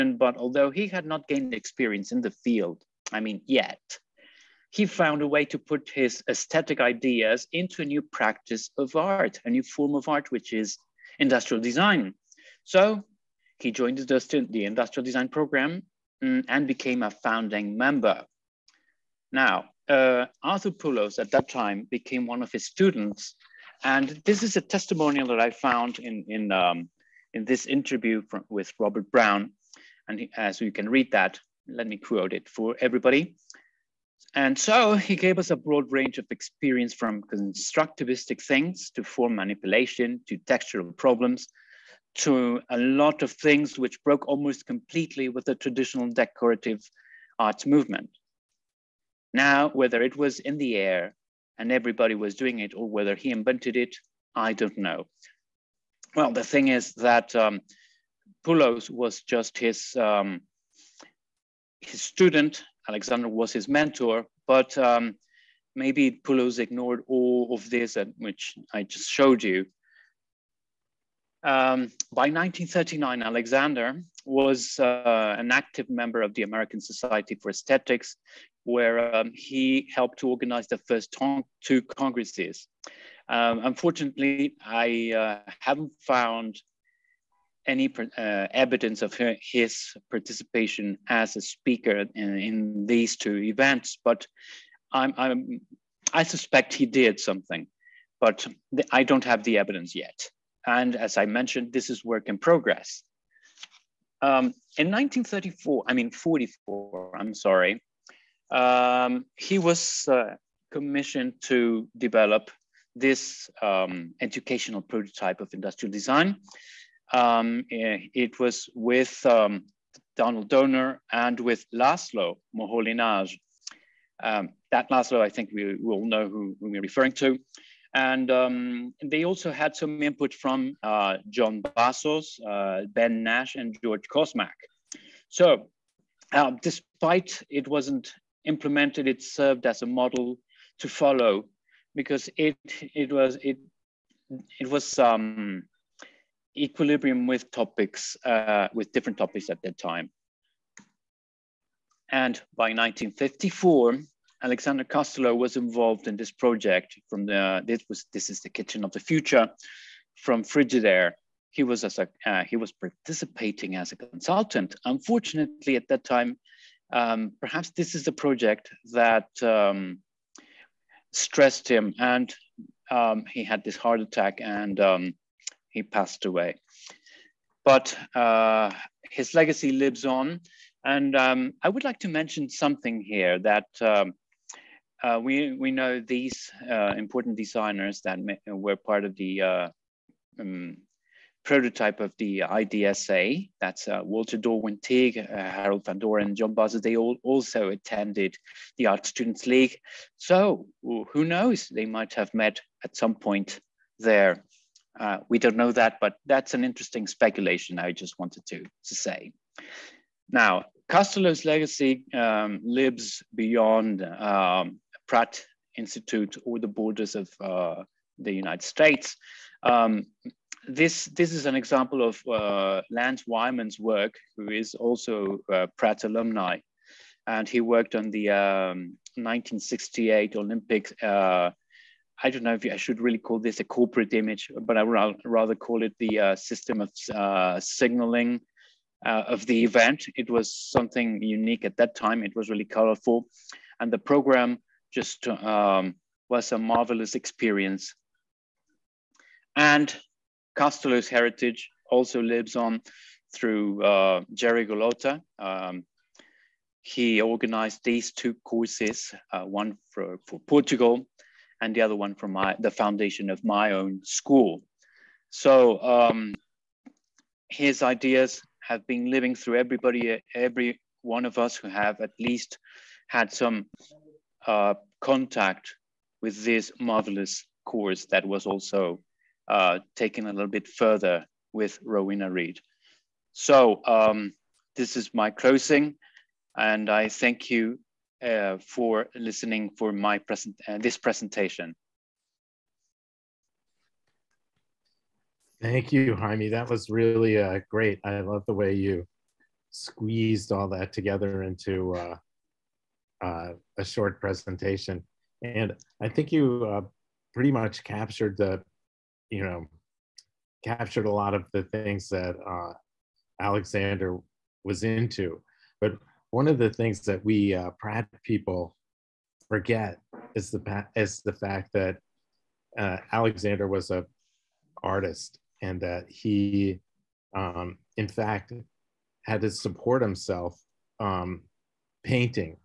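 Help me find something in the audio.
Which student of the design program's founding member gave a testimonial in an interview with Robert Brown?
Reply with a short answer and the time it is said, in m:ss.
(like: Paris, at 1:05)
Arthur Pulos, at 0:20.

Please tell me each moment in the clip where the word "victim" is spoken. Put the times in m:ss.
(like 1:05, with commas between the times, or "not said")
not said.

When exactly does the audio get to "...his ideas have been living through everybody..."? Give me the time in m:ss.
4:27.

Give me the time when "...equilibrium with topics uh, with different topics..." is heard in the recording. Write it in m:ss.
2:26.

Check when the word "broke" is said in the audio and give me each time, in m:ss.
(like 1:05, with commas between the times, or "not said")
0:44.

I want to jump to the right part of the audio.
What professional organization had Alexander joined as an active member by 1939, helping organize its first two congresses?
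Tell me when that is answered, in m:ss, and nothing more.
1:16.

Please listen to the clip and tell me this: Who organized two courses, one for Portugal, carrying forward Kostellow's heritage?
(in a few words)
Jerry Gulotta.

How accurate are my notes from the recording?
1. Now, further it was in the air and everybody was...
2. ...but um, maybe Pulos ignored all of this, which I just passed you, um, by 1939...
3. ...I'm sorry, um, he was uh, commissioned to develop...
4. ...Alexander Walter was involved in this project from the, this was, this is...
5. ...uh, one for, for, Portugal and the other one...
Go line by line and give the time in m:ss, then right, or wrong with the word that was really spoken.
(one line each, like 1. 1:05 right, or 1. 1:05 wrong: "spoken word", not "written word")
1. 0:49 wrong: "whether", not "further"
2. 1:04 wrong: "showed", not "passed"
3. 1:47 right
4. 2:34 wrong: "Kostellow", not "Walter"
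5. 4:19 right.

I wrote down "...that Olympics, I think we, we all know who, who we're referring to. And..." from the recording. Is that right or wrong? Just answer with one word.
wrong.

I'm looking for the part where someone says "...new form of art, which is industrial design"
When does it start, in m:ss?
0:09.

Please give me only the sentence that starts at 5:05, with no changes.
And I think you uh, pretty much captured the, you know, captured a lot of the things that uh, Alexander was into.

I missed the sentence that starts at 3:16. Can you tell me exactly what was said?
They all also attended the Art Students League.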